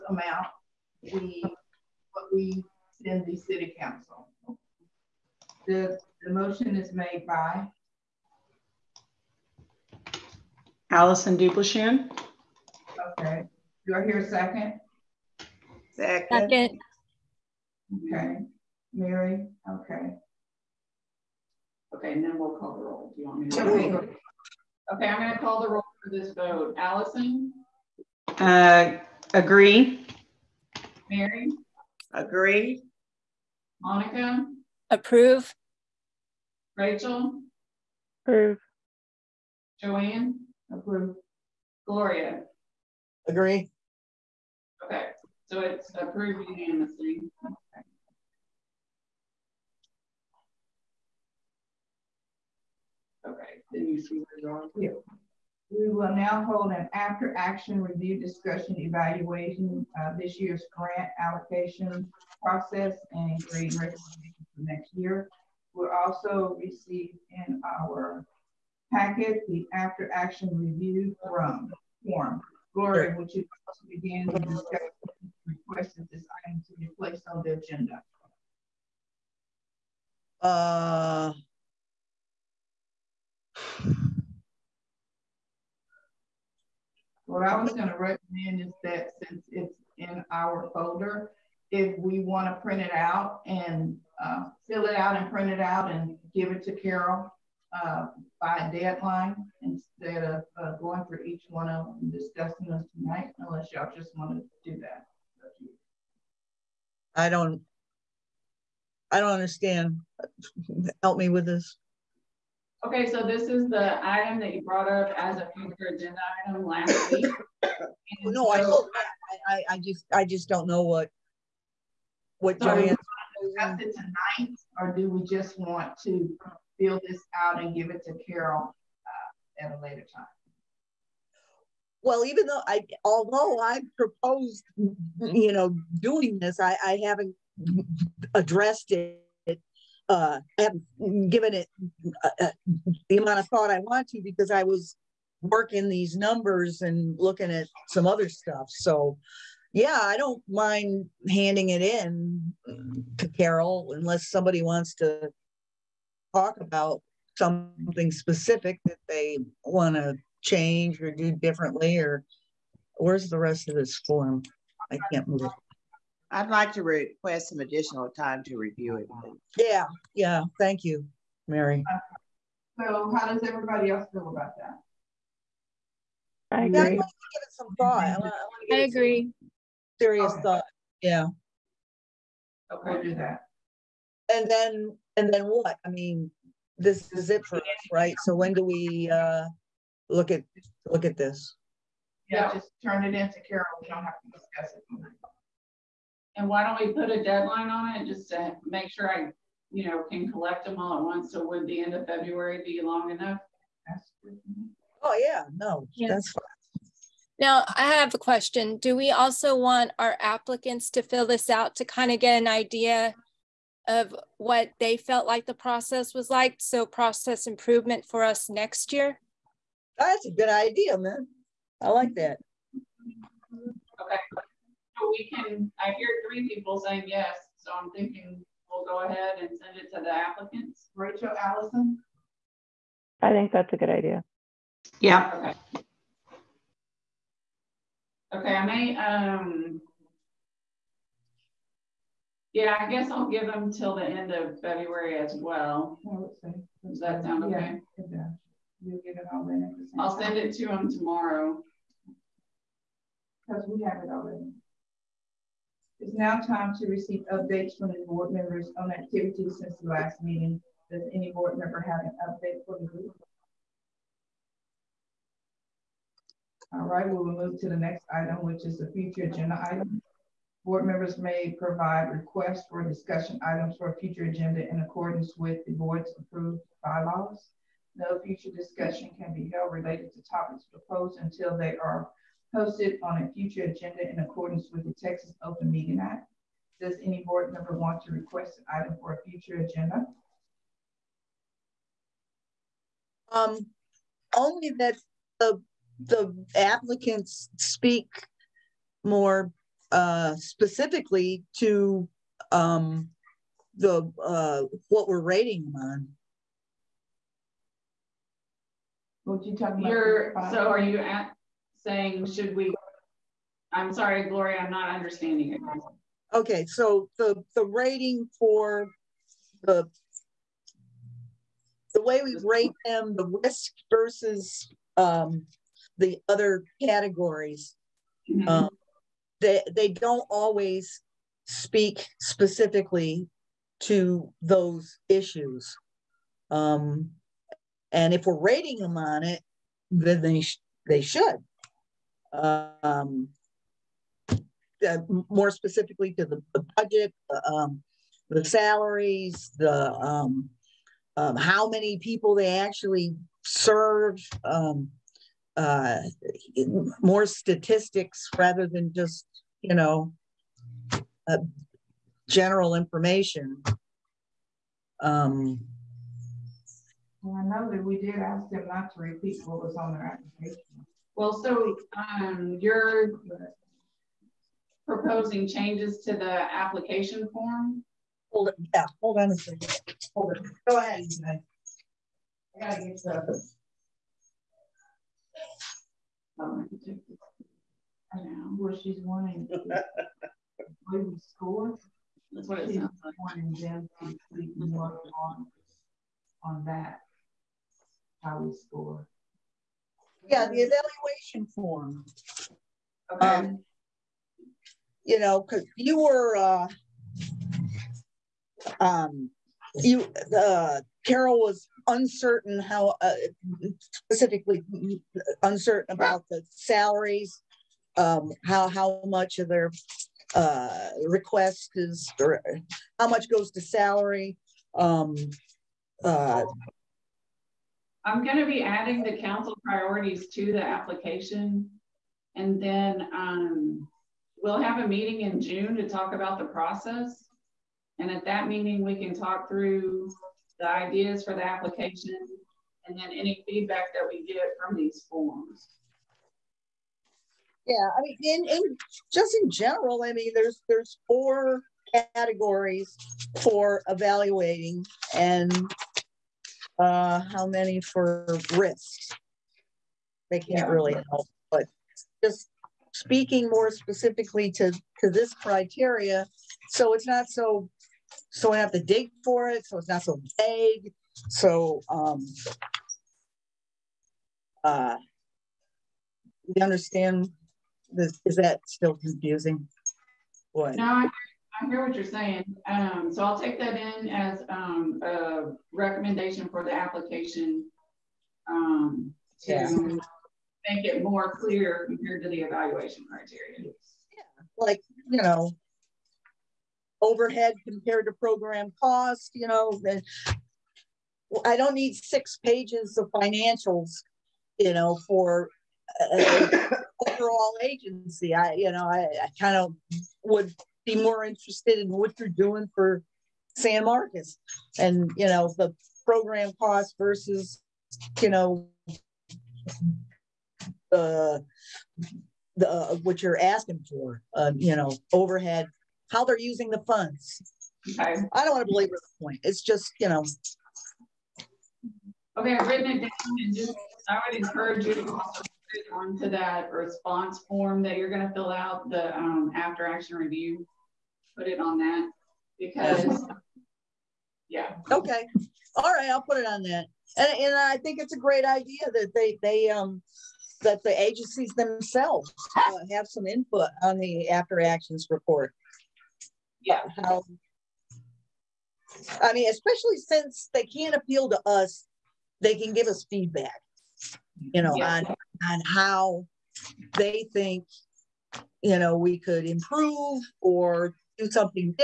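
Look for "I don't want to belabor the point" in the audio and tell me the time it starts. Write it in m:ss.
8:48.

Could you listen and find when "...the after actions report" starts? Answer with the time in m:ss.
9:13.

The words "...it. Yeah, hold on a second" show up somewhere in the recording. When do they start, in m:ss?
6:18.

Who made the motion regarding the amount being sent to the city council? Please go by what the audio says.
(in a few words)
Allison Dublishan.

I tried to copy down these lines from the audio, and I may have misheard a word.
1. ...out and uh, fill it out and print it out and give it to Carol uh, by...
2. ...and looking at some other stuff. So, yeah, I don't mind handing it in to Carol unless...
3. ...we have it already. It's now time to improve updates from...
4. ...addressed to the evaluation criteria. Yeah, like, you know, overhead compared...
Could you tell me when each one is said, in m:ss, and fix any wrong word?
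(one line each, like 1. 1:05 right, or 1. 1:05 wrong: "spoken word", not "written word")
1. 1:32 right
2. 2:26 right
3. 4:13 wrong: "receive", not "improve"
4. 8:11 wrong: "compared", not "addressed".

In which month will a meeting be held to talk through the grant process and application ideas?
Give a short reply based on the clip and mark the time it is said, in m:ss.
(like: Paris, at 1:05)
June, at 7:15.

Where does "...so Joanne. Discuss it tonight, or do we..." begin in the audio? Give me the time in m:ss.
2:02.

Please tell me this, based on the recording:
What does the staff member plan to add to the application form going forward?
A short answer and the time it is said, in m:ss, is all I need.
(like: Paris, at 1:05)
Council priorities, at 7:09.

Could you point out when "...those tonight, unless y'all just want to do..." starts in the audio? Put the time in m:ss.
1:42.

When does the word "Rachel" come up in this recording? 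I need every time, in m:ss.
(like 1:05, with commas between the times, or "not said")
0:36, 3:50.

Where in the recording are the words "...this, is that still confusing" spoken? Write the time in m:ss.
7:57.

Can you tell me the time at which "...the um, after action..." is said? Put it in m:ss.
8:58.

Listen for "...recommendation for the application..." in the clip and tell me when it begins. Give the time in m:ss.
8:05.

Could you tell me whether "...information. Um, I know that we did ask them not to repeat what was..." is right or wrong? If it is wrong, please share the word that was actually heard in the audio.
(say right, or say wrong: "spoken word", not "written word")
right.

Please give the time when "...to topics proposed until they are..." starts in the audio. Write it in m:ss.
4:40.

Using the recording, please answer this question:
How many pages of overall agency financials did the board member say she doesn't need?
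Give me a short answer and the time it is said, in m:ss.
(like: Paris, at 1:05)
6, at 8:21.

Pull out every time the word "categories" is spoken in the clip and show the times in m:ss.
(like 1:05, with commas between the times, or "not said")
5:26, 7:32.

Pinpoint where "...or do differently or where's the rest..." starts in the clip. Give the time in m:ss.
2:41.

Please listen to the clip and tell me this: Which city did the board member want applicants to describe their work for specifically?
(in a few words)
San Marcos.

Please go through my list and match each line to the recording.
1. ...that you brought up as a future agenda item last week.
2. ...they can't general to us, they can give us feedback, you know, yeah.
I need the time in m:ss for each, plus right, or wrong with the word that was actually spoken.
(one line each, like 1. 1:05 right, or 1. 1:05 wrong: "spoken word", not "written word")
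1. 1:54 right
2. 9:20 wrong: "appeal", not "general".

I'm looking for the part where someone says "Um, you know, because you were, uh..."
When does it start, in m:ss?
6:43.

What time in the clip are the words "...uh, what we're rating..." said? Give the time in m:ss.
5:04.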